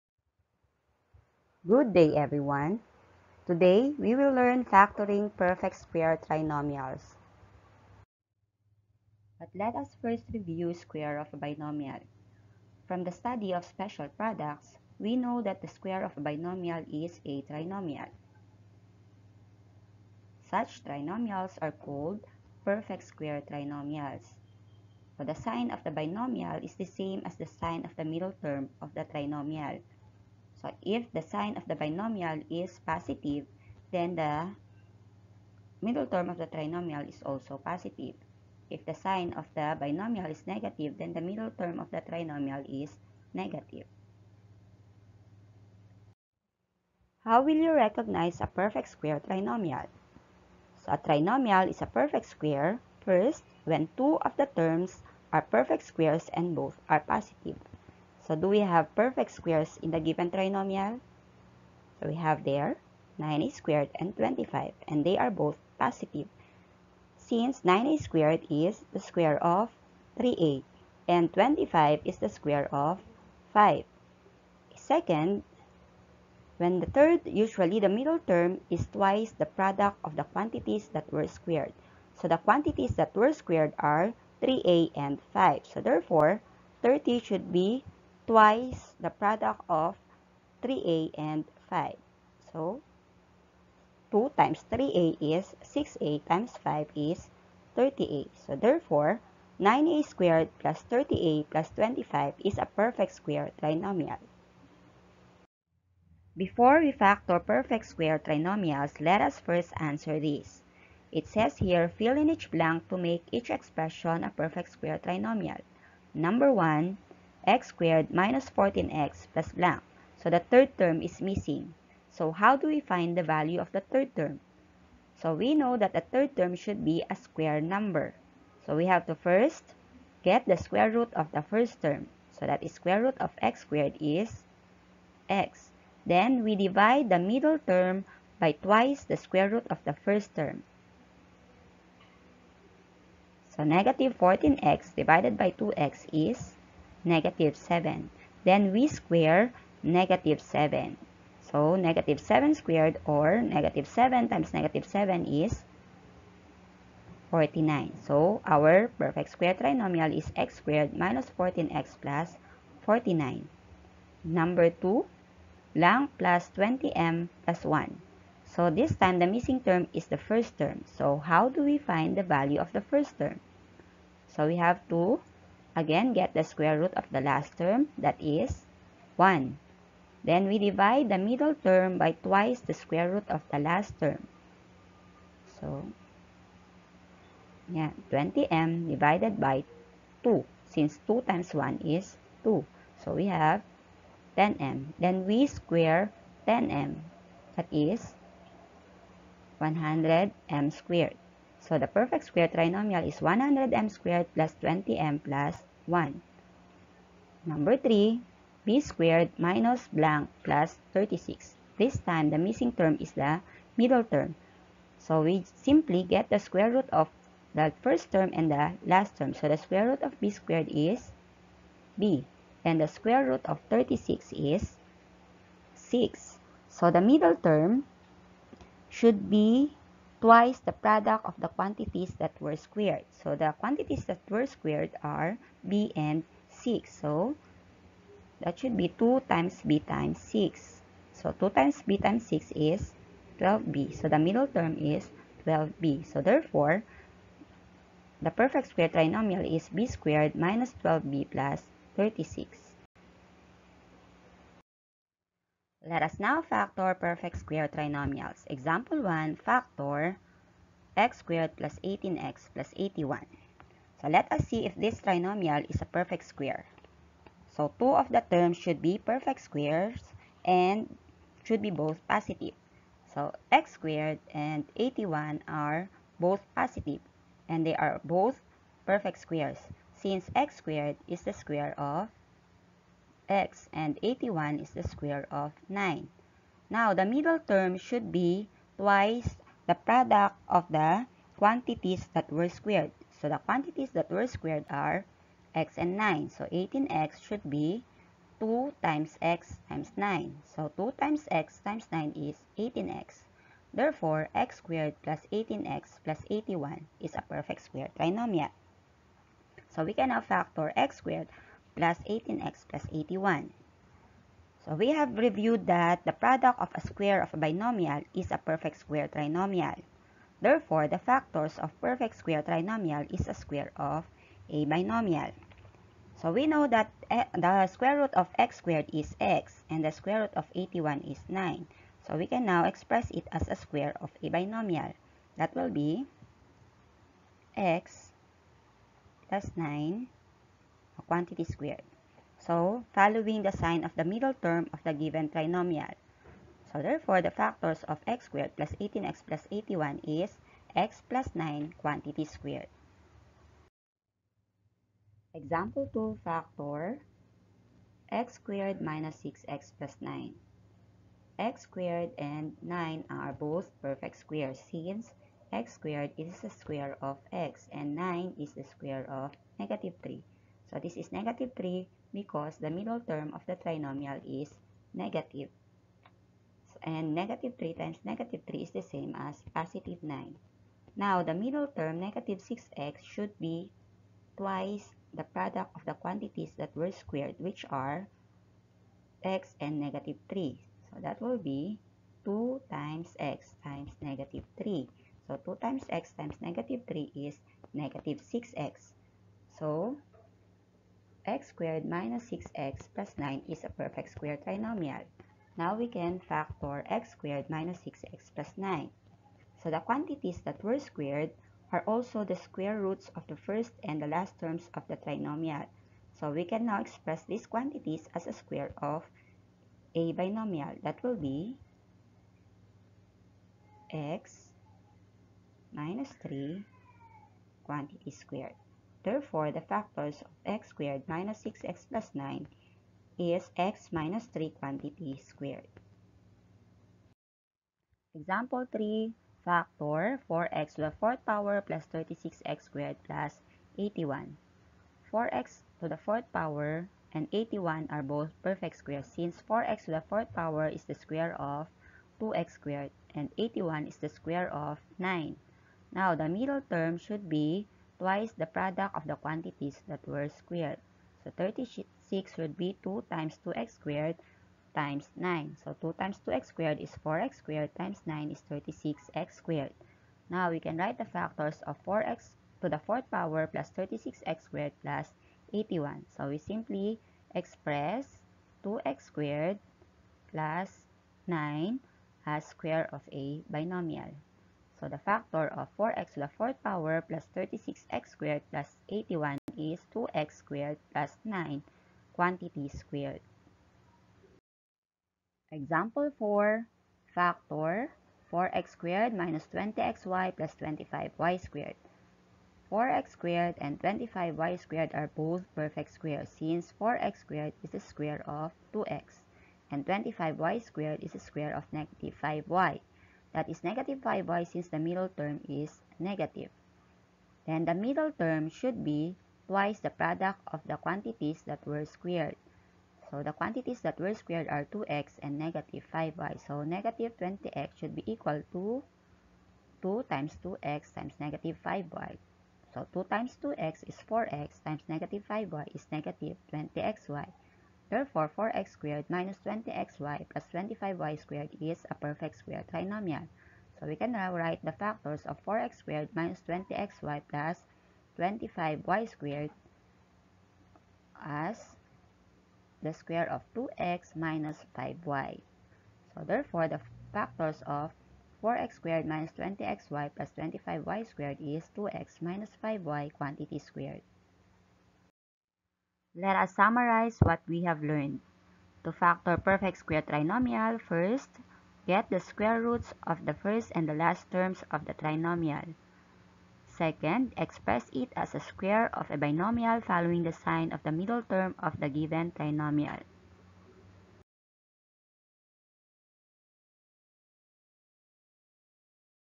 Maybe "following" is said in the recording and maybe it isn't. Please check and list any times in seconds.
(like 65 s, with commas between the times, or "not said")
342 s, 579 s.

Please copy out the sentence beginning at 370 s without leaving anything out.
So this is negative 3 because the middle term of the trinomial is negative.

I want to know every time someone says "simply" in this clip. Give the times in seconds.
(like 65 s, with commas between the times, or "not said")
215 s, 476 s.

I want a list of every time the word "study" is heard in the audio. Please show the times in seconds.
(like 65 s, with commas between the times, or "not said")
13 s.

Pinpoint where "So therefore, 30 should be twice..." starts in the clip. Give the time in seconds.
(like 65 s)
85 s.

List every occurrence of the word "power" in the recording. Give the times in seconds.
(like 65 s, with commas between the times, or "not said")
441 s, 446 s, 450 s, 473 s, 486 s.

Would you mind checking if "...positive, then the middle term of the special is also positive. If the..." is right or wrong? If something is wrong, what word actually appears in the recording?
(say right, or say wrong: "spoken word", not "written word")
wrong: "trinomial", not "special".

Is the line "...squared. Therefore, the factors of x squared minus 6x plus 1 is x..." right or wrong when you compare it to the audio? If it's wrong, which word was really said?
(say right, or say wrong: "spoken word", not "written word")
wrong: "9", not "1".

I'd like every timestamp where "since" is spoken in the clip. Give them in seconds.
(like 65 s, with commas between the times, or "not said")
67 s, 190 s, 279 s, 364 s, 449 s, 506 s, 514 s.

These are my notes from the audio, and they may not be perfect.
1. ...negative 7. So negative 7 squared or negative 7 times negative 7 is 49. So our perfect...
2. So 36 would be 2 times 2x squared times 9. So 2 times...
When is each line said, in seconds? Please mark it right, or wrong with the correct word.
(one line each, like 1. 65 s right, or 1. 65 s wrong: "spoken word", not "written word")
1. 149 s right
2. 461 s right.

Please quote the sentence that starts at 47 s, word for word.
How will you recognize a perfect square trinomial?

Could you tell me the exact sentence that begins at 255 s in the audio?
Let us now factor perfect square trinomials.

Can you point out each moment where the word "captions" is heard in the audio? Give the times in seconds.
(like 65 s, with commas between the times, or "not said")
not said.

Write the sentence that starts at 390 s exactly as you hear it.
So that will be 2 times x times negative 3.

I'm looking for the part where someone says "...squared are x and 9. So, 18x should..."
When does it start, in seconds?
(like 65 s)
294 s.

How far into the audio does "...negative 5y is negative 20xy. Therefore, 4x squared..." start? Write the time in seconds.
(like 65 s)
534 s.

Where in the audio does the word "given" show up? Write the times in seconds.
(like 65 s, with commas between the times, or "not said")
59 s, 344 s, 581 s.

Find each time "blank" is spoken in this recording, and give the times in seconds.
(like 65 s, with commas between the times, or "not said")
112 s, 119 s, 209 s.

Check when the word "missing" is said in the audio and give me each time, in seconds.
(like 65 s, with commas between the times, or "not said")
121 s, 169 s, 212 s.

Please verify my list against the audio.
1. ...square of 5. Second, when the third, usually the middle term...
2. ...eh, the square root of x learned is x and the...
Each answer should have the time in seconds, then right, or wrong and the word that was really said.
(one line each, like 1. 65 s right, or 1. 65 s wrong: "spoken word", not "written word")
1. 72 s right
2. 327 s wrong: "squared", not "learned".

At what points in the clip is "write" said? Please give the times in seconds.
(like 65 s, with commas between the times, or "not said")
470 s, 544 s.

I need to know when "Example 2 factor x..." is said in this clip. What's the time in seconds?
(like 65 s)
355 s.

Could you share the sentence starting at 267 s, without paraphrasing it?
So two of the terms should be perfect squares and should be both positive.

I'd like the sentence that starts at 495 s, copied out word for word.
Example 4, factor 4x squared minus 20xy plus 25y squared.